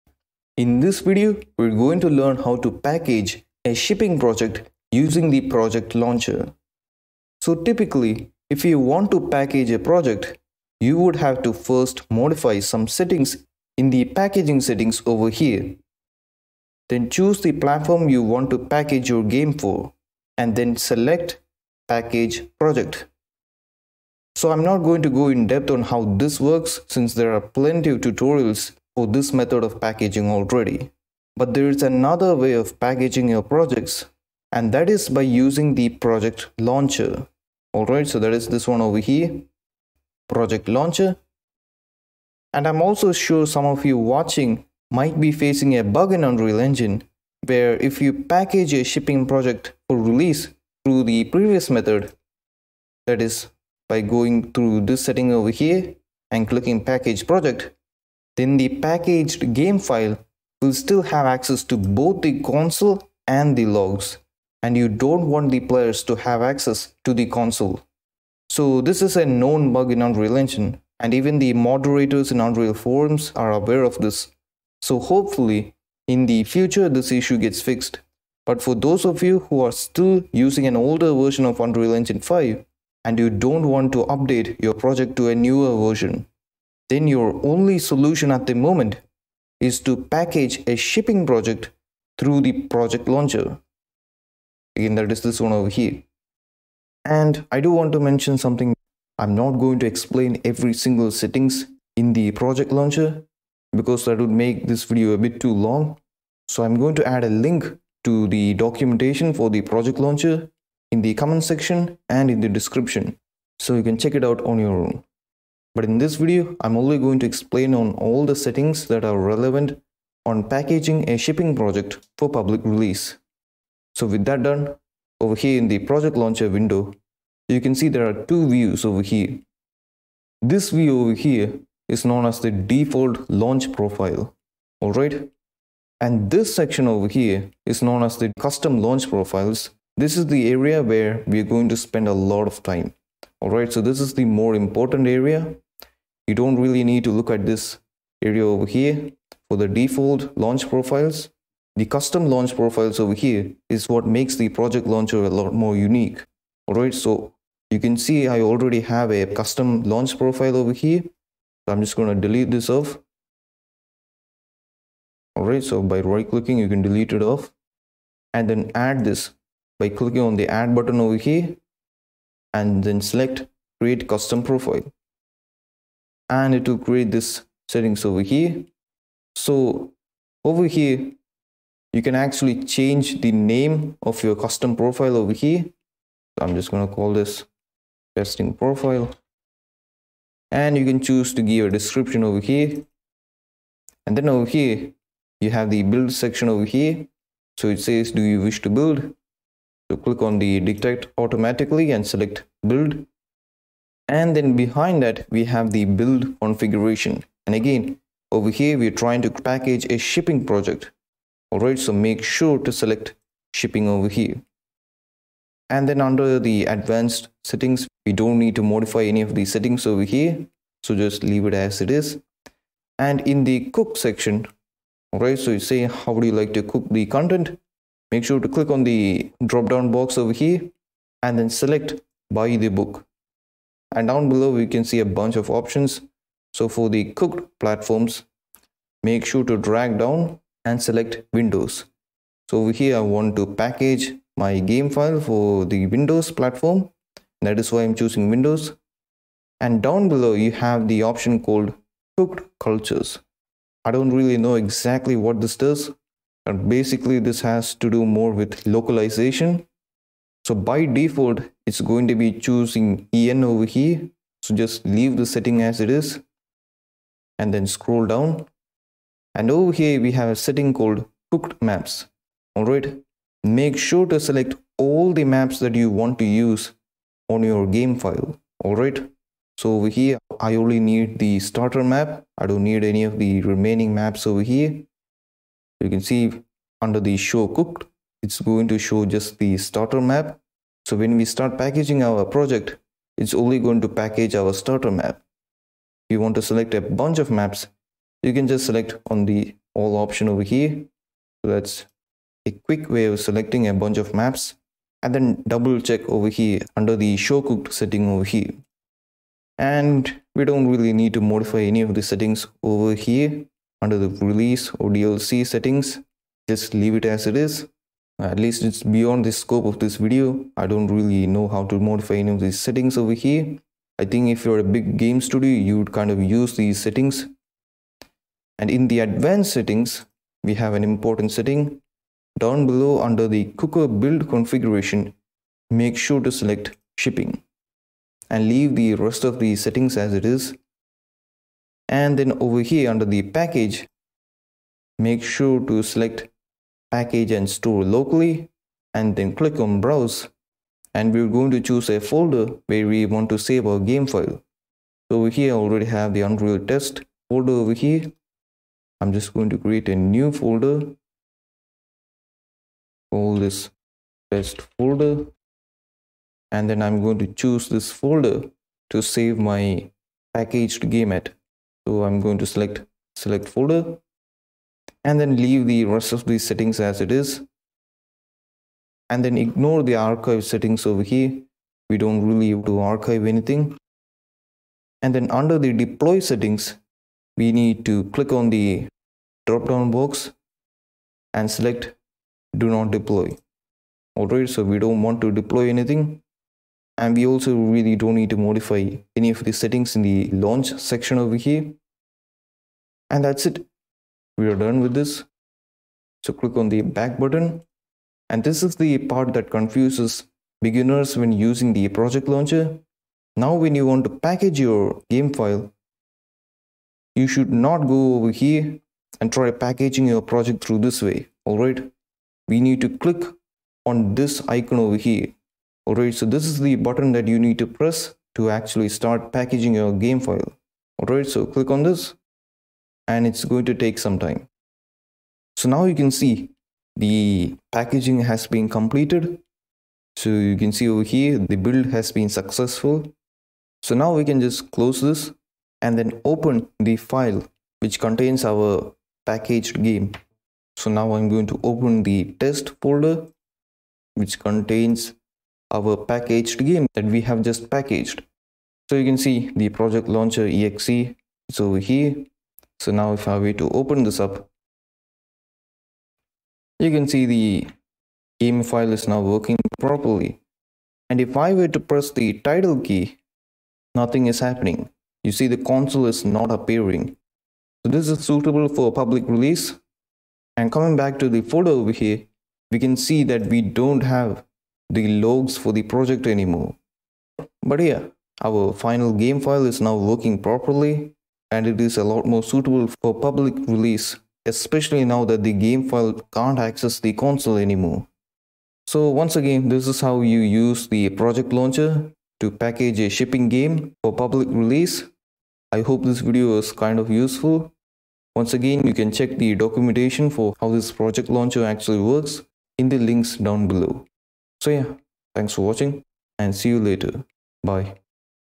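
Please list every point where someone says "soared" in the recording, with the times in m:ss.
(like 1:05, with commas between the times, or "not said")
not said.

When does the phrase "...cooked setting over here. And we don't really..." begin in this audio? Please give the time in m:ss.
5:07.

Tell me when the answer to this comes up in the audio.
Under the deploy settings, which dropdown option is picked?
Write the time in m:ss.
6:32.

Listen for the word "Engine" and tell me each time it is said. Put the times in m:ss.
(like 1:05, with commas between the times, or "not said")
0:46, 1:10, 1:21.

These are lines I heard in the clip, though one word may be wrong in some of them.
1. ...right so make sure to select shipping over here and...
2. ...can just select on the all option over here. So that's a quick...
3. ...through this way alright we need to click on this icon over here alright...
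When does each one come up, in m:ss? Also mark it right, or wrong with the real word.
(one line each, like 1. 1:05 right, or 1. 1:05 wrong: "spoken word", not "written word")
1. 3:31 right
2. 4:58 right
3. 7:00 right.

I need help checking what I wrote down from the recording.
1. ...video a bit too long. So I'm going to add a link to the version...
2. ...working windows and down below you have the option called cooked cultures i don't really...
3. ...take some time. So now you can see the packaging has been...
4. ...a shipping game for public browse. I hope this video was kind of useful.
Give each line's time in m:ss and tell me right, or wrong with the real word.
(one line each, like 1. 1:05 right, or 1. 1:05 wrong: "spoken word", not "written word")
1. 1:44 wrong: "documentation", not "version"
2. 4:08 wrong: "choosing", not "working"
3. 7:13 right
4. 8:22 wrong: "release", not "browse".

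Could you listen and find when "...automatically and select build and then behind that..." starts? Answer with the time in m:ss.
3:21.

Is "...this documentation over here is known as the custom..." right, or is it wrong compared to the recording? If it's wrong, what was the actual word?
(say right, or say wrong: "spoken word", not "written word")
wrong: "section", not "documentation".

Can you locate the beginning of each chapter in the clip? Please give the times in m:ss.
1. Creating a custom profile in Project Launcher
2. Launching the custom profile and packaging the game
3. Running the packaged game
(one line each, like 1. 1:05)
1. 2:03
2. 6:48
3. 7:42.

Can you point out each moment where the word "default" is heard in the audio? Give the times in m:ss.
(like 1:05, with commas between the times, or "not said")
2:12, 2:29, 4:20.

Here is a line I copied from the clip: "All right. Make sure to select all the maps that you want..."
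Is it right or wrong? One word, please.
right.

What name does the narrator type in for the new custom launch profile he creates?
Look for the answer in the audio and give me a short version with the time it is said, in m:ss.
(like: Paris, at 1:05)
testing profile, at 3:08.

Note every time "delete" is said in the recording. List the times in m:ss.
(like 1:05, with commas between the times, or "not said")
2:42, 2:46.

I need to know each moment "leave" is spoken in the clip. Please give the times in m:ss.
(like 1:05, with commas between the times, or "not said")
3:41, 4:24, 5:16, 5:38, 6:15.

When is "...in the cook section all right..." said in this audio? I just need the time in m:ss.
3:43.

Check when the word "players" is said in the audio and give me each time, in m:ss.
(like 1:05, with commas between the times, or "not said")
1:05.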